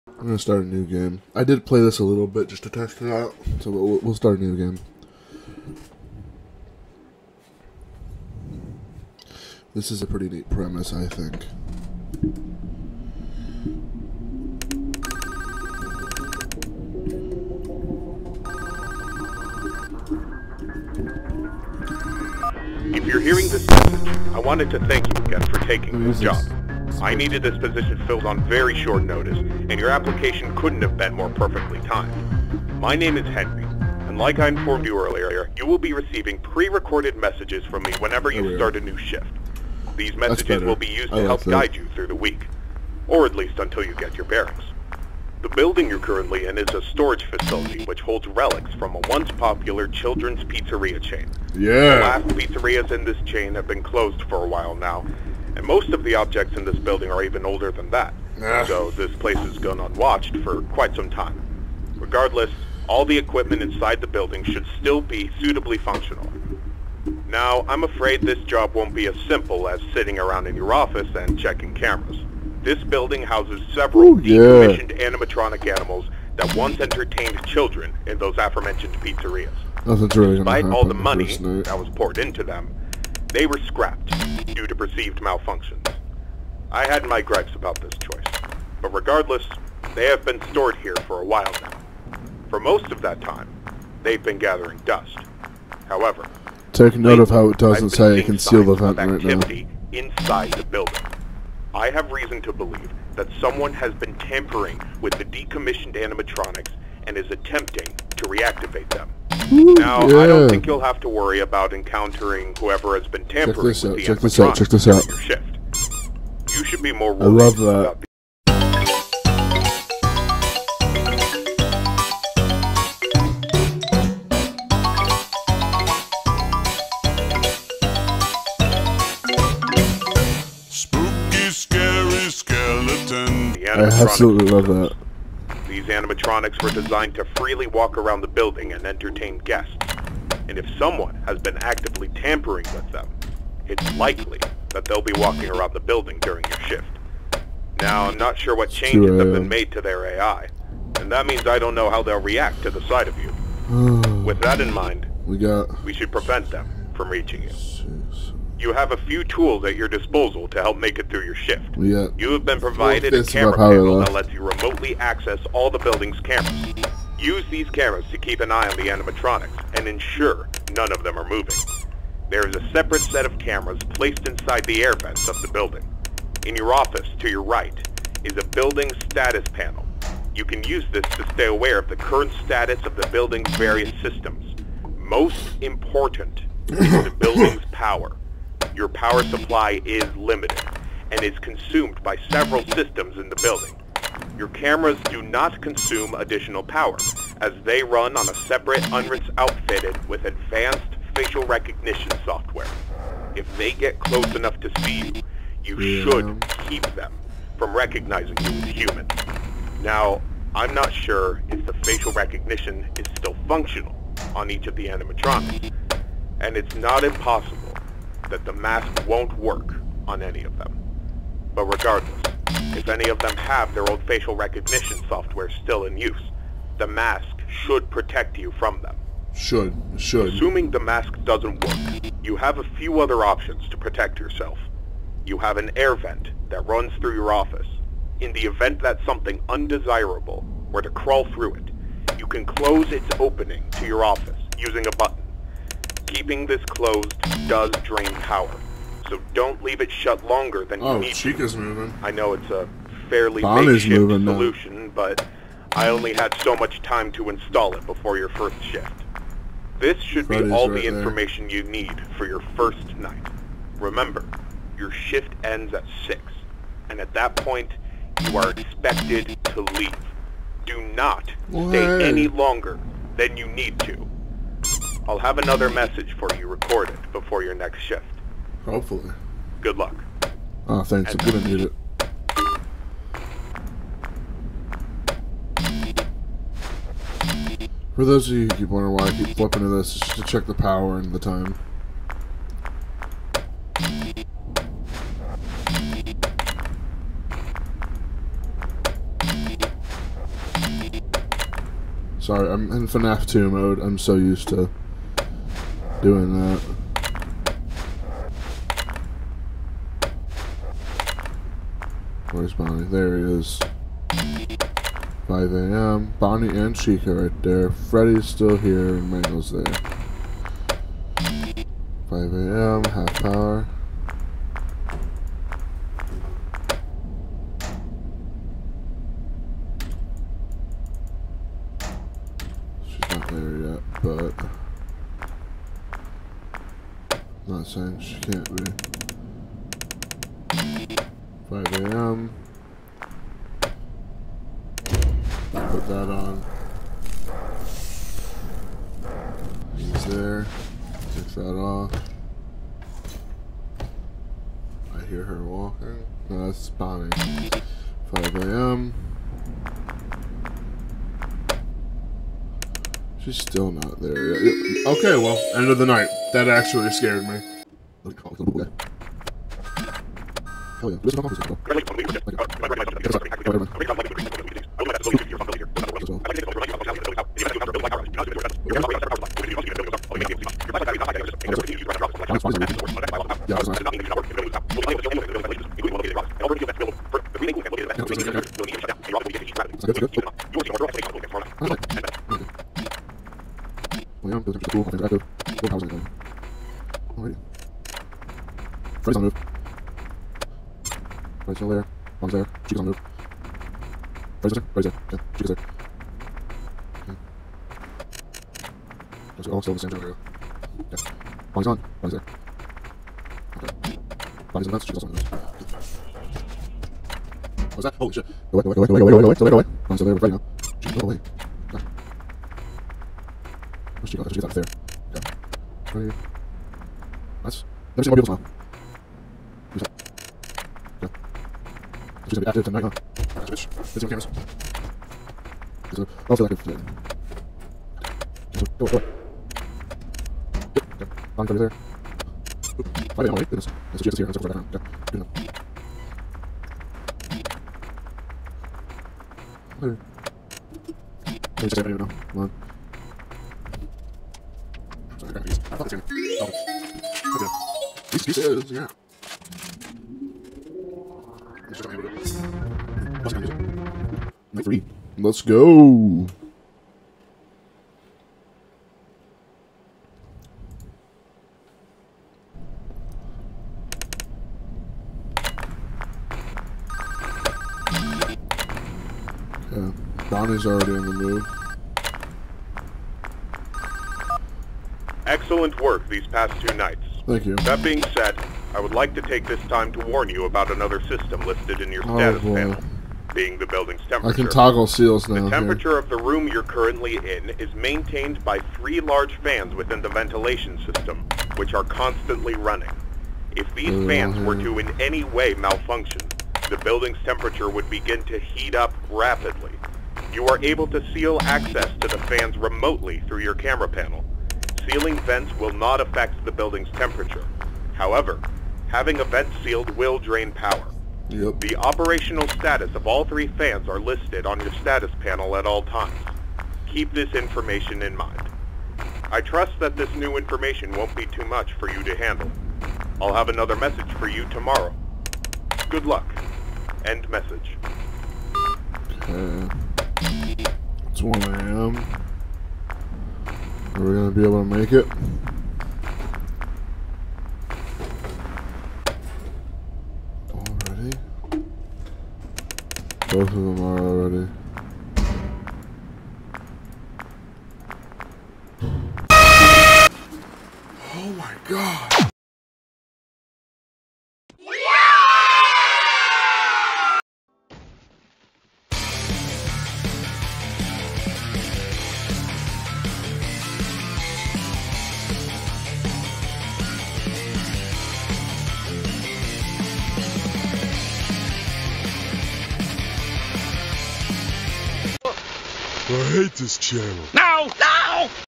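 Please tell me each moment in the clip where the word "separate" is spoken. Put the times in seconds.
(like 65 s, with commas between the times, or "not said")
172 s, 198 s.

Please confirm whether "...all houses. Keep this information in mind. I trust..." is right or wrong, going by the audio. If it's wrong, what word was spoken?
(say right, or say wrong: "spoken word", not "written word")
wrong: "times", not "houses".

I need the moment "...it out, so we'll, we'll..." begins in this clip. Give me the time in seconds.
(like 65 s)
3 s.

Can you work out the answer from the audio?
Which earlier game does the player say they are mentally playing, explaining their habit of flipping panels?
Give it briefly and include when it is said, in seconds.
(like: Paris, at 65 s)
FNAF 2, at 302 s.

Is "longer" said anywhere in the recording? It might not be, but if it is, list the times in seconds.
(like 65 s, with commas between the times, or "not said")
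250 s, 272 s.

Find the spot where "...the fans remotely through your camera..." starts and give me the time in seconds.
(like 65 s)
512 s.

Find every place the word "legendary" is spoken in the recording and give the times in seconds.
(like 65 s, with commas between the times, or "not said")
not said.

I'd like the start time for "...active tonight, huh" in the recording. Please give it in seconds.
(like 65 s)
432 s.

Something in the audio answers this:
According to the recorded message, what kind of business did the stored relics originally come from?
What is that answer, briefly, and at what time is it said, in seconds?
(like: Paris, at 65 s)
Children's pizzeria chain, at 49 s.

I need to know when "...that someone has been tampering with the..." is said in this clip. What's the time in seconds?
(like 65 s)
103 s.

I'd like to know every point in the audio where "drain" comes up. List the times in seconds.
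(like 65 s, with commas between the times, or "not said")
247 s, 520 s.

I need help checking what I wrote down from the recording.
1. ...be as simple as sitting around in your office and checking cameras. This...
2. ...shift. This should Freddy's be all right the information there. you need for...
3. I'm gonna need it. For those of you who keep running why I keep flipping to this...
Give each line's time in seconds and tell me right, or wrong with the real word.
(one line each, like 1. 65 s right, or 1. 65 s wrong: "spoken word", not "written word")
1. 68 s right
2. 258 s right
3. 281 s wrong: "wondering", not "running".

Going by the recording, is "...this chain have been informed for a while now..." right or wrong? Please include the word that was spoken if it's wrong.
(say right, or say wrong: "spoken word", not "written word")
wrong: "closed", not "informed".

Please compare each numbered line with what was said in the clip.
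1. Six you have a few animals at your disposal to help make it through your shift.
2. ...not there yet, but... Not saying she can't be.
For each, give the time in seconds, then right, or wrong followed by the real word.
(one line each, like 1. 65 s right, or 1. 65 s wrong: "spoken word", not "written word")
1. 157 s wrong: "tools", not "animals"
2. 333 s right.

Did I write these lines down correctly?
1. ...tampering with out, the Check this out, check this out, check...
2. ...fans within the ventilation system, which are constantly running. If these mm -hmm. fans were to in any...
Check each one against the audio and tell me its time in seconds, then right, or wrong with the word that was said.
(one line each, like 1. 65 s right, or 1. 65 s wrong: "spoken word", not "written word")
1. 113 s right
2. 499 s right.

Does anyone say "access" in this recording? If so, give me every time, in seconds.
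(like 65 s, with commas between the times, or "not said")
164 s, 511 s.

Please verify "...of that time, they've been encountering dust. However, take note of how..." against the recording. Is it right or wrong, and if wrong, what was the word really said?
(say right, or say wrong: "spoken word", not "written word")
wrong: "gathering", not "encountering".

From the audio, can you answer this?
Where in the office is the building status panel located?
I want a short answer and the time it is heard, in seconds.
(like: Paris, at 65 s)
To your right, at 177 s.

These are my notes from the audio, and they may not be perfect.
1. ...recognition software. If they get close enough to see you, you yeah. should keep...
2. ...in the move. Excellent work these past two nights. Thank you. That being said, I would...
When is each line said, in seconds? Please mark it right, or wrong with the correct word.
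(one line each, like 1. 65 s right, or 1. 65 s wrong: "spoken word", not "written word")
1. 201 s right
2. 480 s right.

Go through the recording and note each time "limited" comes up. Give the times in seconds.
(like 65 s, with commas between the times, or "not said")
190 s.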